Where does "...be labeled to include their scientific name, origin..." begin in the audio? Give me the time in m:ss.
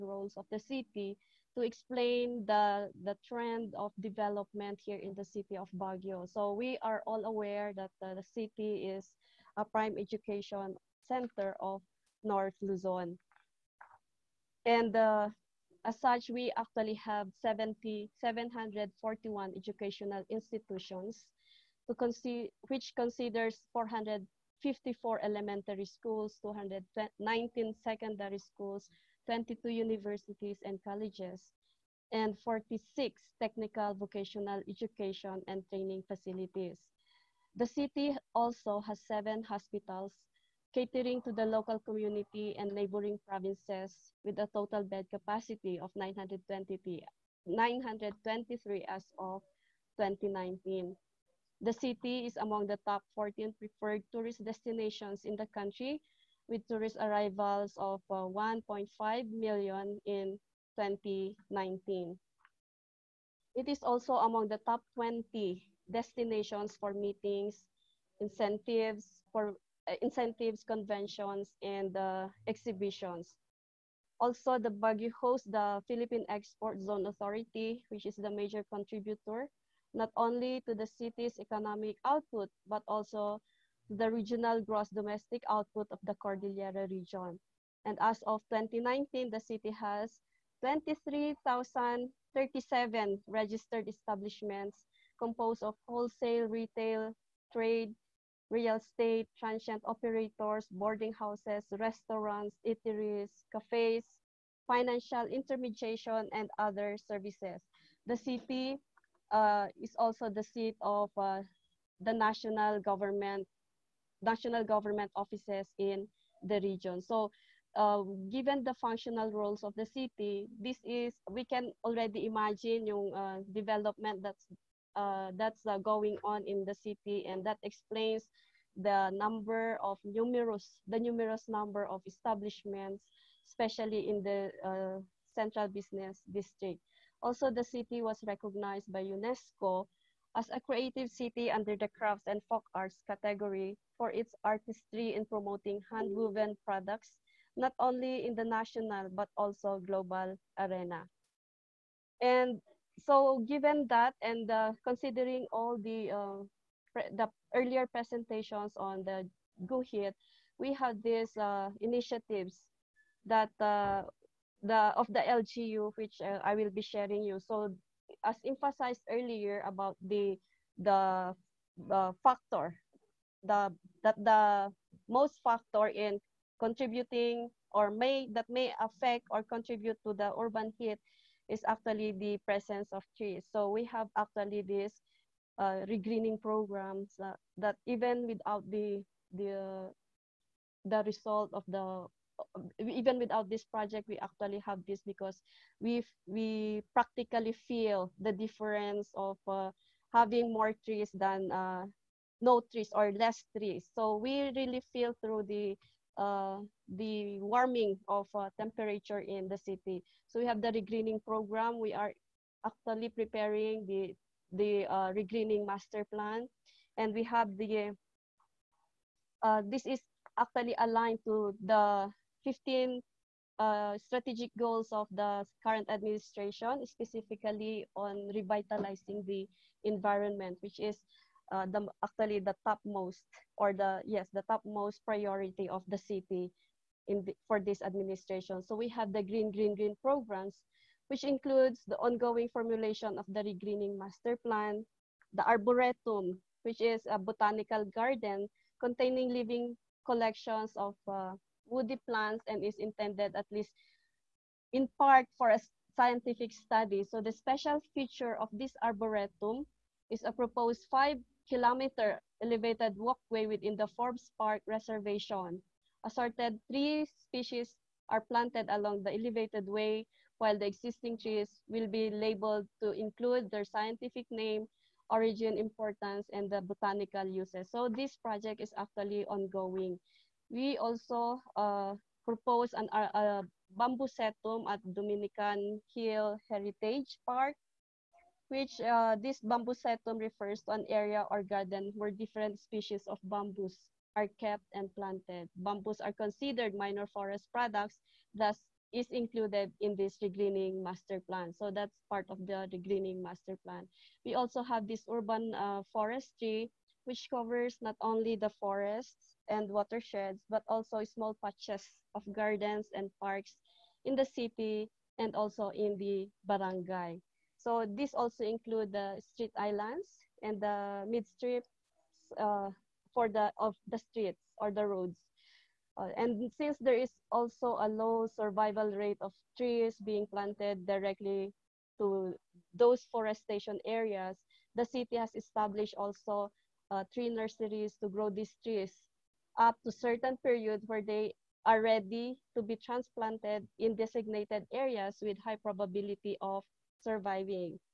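4:31.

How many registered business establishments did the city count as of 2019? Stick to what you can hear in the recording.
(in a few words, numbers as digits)
23,037.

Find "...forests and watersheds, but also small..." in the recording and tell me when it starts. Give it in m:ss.
5:08.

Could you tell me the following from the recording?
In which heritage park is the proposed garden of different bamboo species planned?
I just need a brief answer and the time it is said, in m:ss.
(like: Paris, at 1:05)
Dominican Hill Heritage Park, at 4:44.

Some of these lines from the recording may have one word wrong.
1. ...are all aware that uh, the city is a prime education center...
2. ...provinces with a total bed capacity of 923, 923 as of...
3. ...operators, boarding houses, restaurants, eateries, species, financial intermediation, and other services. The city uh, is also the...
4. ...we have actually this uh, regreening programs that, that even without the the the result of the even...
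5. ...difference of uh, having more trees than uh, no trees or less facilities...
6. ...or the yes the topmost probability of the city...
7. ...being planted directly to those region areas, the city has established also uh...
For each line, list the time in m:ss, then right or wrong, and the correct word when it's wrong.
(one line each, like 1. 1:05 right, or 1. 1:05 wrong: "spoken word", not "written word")
1. 0:06 right
2. 0:43 right
3. 1:39 wrong: "cafes", not "species"
4. 3:03 right
5. 3:18 wrong: "trees", not "facilities"
6. 3:53 wrong: "priority", not "probability"
7. 5:30 wrong: "forestation", not "region".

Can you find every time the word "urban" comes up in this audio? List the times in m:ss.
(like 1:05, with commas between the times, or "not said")
3:00, 5:05.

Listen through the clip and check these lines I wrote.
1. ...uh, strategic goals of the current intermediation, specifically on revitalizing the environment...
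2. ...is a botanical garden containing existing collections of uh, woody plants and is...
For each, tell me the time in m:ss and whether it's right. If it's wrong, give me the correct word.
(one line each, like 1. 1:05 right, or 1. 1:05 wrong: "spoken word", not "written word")
1. 3:43 wrong: "administration", not "intermediation"
2. 4:06 wrong: "living", not "existing".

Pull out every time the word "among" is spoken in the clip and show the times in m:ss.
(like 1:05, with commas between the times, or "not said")
0:52, 1:04.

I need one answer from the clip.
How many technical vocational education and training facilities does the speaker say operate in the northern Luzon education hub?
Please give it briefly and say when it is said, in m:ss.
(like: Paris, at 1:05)
46, at 0:32.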